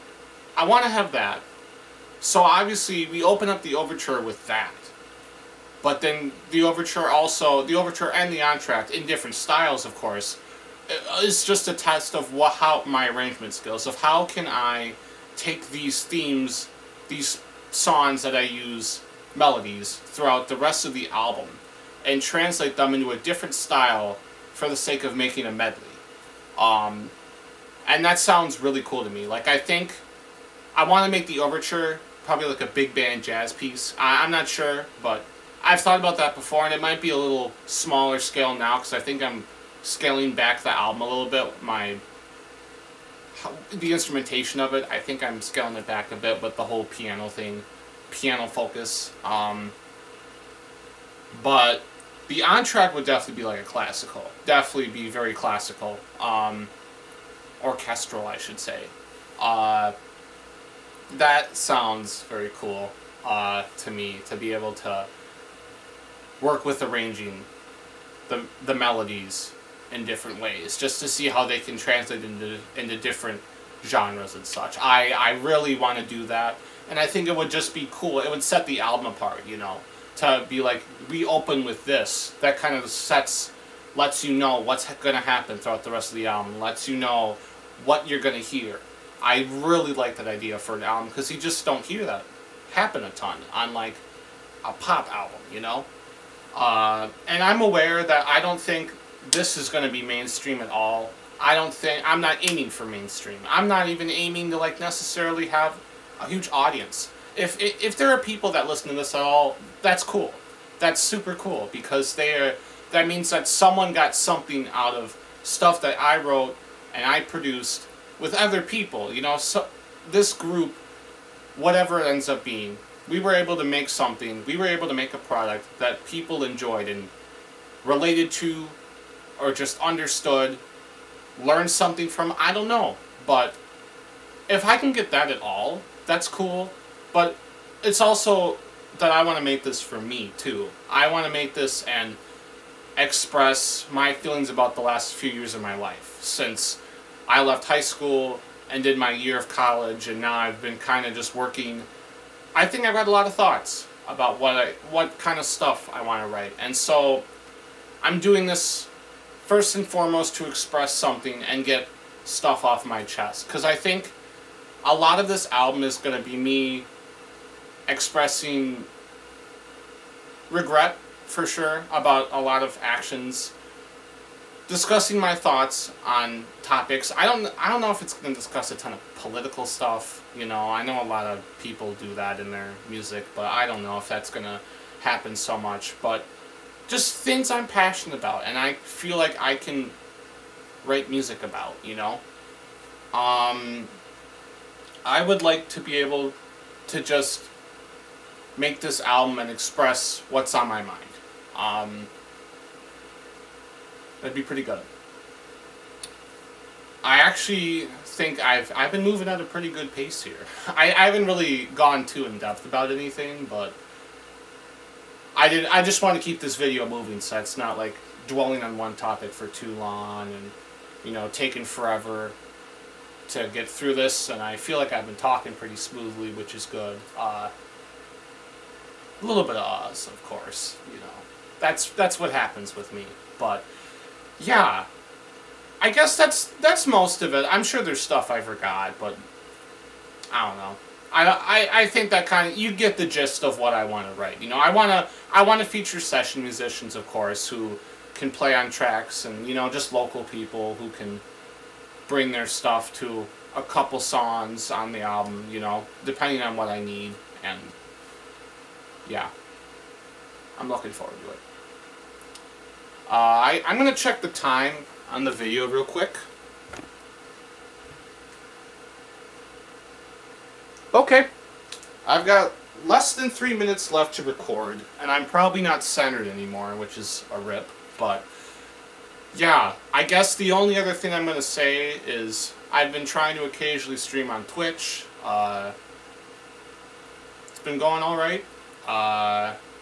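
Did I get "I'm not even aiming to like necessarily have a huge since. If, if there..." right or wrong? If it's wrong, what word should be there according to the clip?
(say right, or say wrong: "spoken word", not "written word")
wrong: "audience", not "since".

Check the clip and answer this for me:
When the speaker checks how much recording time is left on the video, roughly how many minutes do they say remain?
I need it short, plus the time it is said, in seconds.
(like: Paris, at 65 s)
3 minutes, at 273 s.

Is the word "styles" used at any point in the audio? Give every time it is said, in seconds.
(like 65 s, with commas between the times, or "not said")
9 s, 23 s.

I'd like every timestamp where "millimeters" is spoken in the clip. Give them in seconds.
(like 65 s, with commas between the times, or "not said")
not said.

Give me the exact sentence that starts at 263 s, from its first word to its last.
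Uh, I, I'm going to check the time on the video real quick.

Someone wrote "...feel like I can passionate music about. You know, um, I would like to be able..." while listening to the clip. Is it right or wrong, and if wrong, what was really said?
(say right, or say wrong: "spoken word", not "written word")
wrong: "write", not "passionate".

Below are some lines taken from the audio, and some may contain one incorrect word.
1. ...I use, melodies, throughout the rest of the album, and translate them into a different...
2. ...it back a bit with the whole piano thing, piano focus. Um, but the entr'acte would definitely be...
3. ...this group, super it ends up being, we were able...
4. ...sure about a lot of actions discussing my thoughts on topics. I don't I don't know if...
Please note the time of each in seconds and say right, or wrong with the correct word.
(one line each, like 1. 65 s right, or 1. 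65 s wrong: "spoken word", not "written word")
1. 18 s right
2. 45 s right
3. 120 s wrong: "whatever", not "super"
4. 171 s right.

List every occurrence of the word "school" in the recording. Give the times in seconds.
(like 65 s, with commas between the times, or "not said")
147 s.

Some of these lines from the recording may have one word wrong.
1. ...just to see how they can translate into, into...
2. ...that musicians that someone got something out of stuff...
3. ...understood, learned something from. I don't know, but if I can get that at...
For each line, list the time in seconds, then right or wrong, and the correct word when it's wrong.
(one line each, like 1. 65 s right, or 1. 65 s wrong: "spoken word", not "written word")
1. 70 s right
2. 112 s wrong: "means", not "musicians"
3. 129 s right.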